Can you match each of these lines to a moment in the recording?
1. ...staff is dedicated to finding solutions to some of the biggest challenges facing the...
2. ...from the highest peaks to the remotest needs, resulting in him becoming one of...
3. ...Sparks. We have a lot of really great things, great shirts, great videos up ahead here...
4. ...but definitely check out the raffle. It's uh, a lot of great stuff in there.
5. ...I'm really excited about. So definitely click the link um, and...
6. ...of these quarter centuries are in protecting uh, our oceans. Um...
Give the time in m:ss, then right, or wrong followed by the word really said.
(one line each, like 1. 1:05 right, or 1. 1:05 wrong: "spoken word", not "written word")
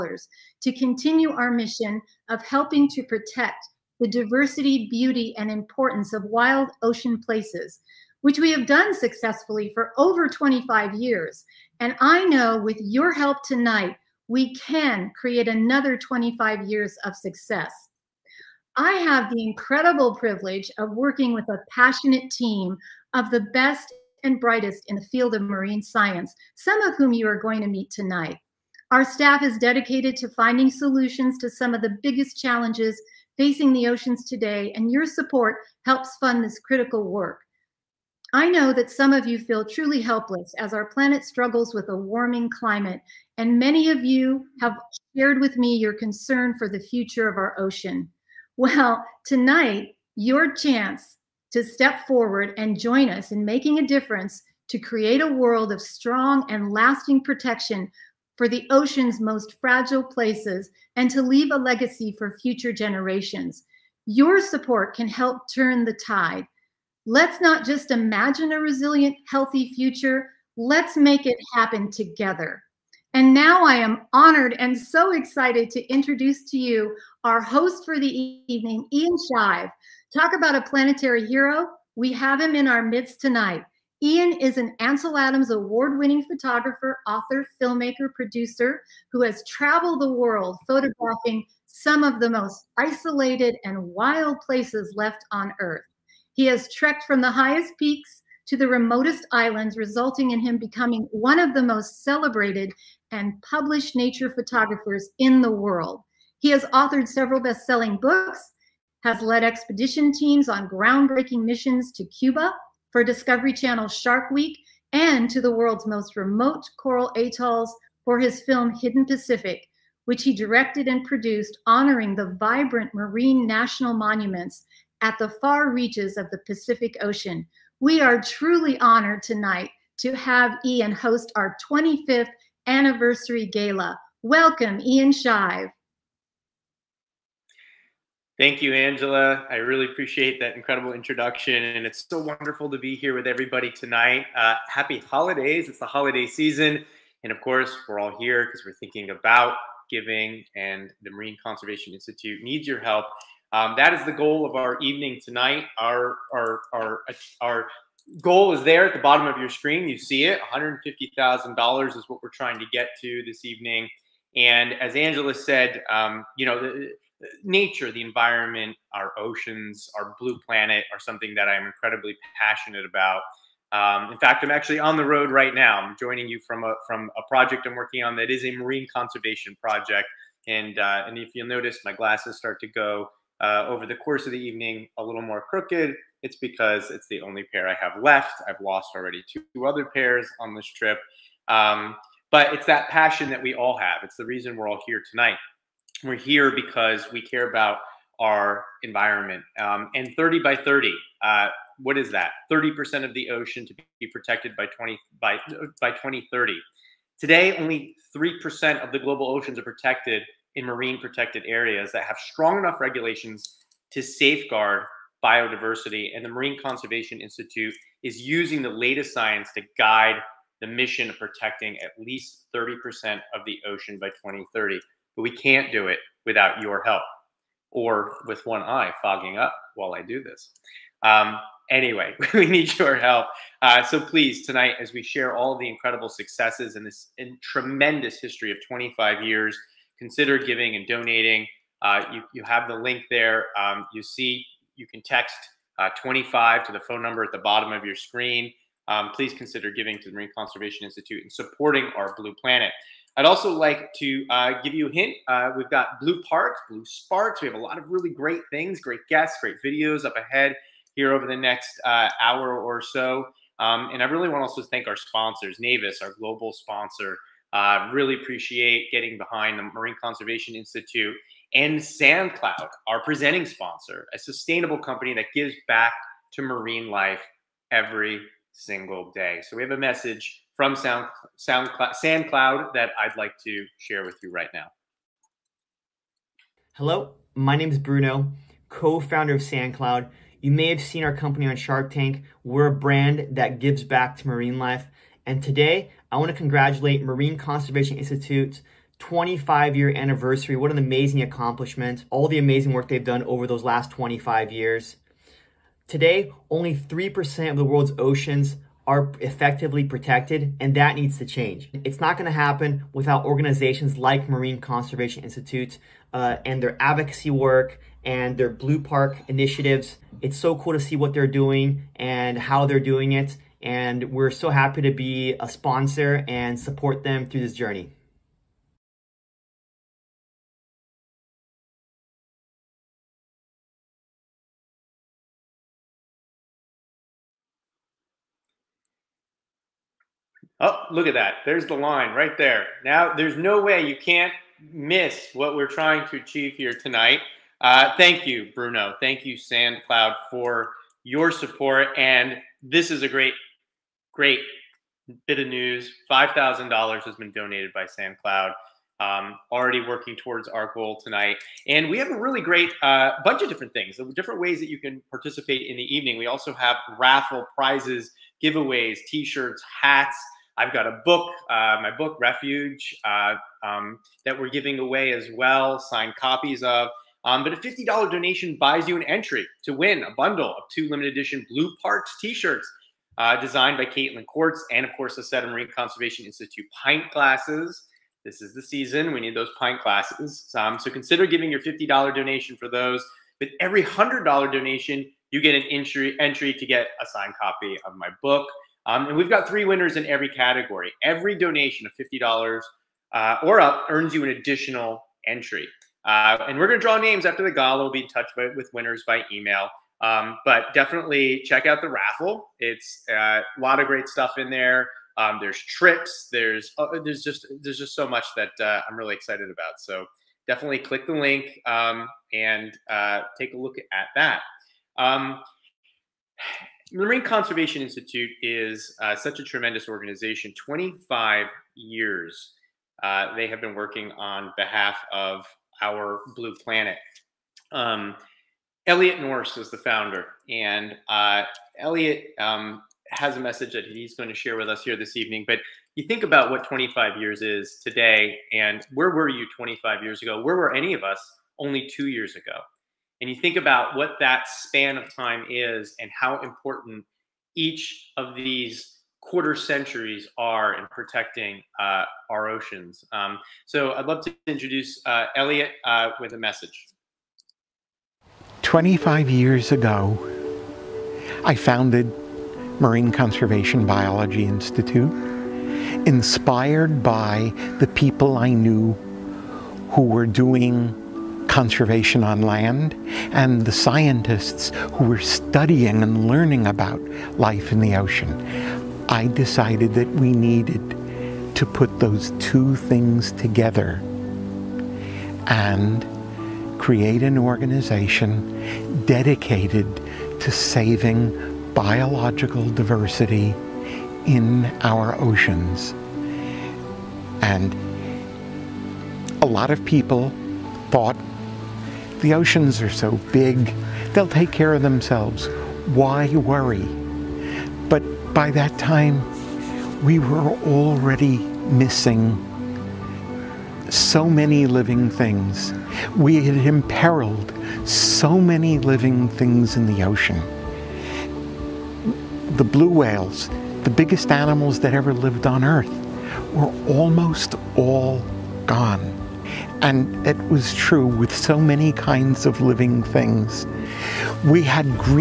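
1. 0:29 right
2. 1:37 wrong: "islands", not "needs"
3. 4:16 wrong: "guests", not "shirts"
4. 6:50 right
5. 6:58 right
6. 7:38 right.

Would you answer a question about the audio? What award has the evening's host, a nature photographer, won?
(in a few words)
Ansel Adams award.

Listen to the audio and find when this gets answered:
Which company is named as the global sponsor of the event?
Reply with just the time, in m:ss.
4:25.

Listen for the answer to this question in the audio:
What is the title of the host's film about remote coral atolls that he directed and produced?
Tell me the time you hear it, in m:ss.
1:58.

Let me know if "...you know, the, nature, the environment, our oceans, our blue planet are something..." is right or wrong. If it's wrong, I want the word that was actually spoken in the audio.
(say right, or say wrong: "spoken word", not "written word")
right.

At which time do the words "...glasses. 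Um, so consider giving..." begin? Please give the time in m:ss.
6:29.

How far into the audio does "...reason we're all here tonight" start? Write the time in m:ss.
3:14.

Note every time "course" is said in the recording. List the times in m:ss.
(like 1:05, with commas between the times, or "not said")
2:27, 3:03, 6:24.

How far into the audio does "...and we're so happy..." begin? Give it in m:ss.
5:23.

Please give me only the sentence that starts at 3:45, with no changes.
But we can't do it without your help or with one eye fogging up while I do this.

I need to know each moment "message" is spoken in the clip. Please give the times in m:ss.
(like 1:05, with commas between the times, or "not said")
4:39, 7:23, 7:46.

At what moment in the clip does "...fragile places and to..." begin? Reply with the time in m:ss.
0:59.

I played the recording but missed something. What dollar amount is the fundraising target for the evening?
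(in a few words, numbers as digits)
$150,000.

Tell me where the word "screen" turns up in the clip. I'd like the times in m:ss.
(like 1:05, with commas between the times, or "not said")
2:39, 4:07.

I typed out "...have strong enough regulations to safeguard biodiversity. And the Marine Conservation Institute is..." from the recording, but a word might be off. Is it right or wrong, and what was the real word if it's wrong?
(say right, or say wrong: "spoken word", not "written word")
right.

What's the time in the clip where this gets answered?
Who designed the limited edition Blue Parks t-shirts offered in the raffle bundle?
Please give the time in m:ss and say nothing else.
6:23.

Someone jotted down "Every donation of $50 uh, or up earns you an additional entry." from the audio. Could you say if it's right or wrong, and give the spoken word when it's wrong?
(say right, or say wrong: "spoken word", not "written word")
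right.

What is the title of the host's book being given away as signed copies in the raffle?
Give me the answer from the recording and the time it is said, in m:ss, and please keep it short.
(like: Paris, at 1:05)
Refuge, at 6:12.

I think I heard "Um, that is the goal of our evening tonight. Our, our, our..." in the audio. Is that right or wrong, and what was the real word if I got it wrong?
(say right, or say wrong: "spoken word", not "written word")
right.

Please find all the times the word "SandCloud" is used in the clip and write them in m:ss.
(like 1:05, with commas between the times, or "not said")
4:31, 4:41, 4:49, 5:49, 5:57.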